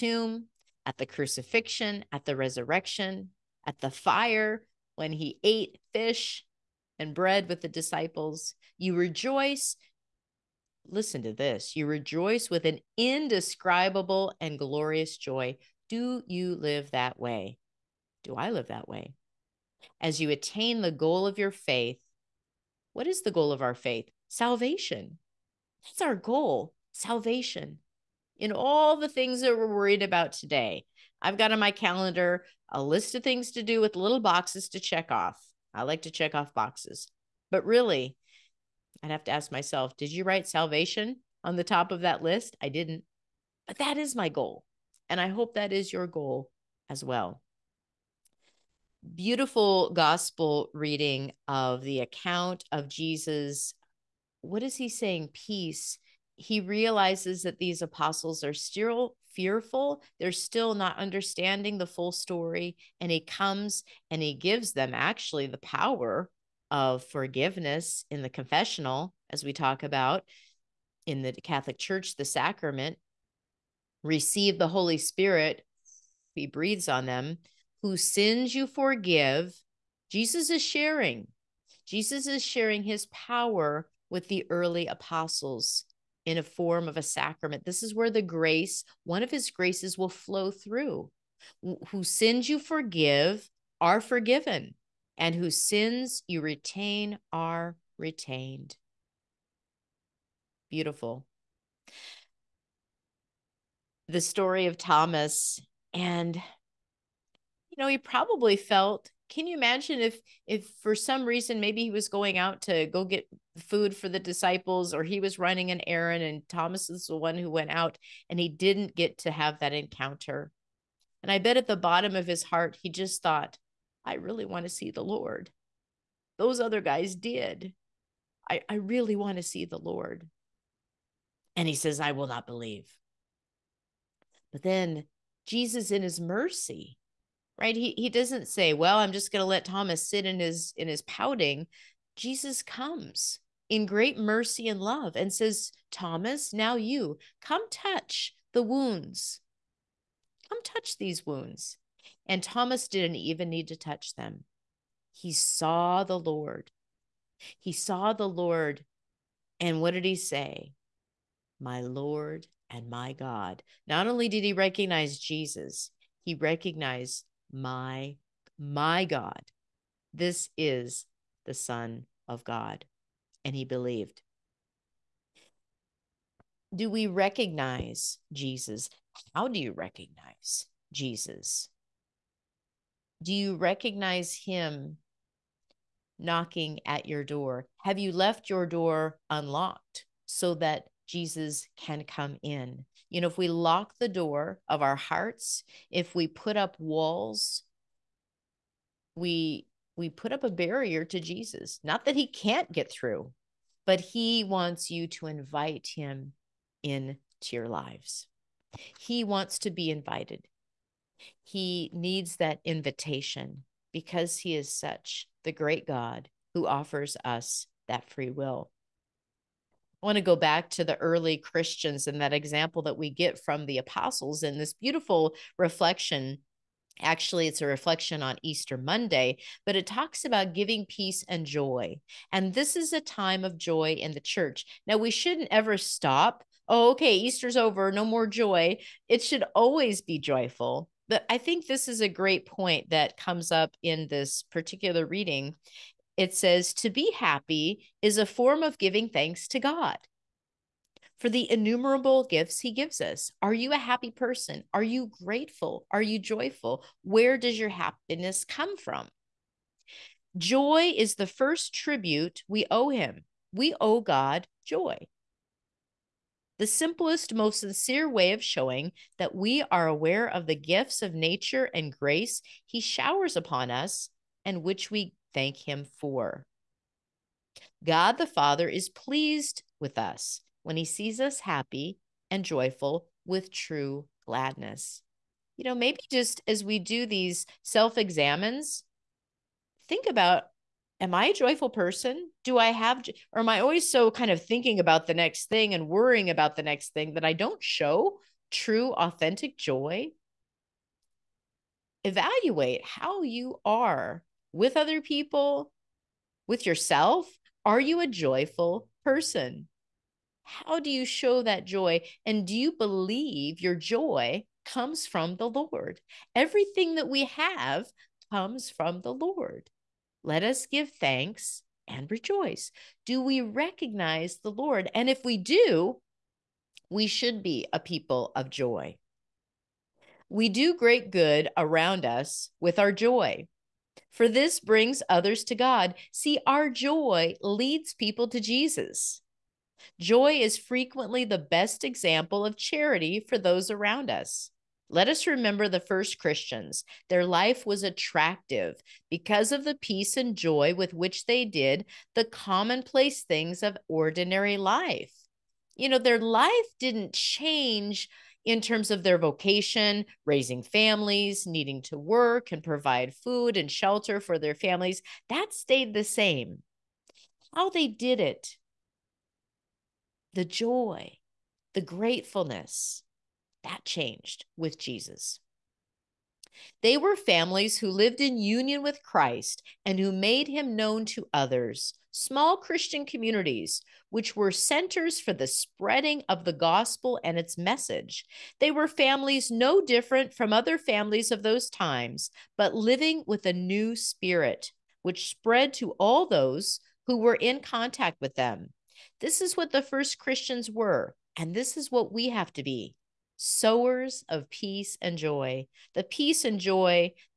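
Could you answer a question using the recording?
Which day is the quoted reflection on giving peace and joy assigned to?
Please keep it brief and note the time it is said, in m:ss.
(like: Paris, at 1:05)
Easter Monday, at 3:48.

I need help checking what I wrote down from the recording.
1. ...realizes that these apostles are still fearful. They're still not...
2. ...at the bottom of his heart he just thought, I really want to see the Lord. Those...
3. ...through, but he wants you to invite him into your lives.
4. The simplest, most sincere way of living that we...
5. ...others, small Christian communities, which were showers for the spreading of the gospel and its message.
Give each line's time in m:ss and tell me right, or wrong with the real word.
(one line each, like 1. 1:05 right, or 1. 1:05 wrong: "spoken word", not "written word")
1. 0:56 right
2. 2:01 right
3. 3:22 right
4. 4:26 wrong: "showing", not "living"
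5. 6:21 wrong: "centers", not "showers".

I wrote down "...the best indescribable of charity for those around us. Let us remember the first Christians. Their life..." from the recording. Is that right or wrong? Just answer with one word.
wrong.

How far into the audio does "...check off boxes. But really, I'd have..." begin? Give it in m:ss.
0:36.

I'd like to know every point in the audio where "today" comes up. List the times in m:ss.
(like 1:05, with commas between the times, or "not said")
0:30.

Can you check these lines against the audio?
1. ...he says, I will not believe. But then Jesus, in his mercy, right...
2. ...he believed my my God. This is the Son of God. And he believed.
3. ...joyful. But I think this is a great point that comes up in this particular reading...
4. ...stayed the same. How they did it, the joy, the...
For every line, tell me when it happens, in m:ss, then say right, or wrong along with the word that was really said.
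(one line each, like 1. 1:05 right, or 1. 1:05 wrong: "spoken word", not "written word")
1. 2:11 right
2. 2:46 wrong: "recognized", not "believed"
3. 4:00 right
4. 6:05 right.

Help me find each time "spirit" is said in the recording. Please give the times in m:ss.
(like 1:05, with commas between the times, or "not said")
1:14, 6:33.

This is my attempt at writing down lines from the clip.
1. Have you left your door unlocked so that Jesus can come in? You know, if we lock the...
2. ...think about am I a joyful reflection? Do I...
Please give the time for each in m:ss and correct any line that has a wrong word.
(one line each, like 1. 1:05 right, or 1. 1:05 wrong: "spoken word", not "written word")
1. 3:07 right
2. 4:49 wrong: "person", not "reflection".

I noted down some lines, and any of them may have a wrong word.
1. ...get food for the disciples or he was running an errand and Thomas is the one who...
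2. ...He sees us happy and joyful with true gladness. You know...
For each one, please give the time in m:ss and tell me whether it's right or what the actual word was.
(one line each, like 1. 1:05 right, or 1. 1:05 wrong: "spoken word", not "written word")
1. 1:53 right
2. 4:40 right.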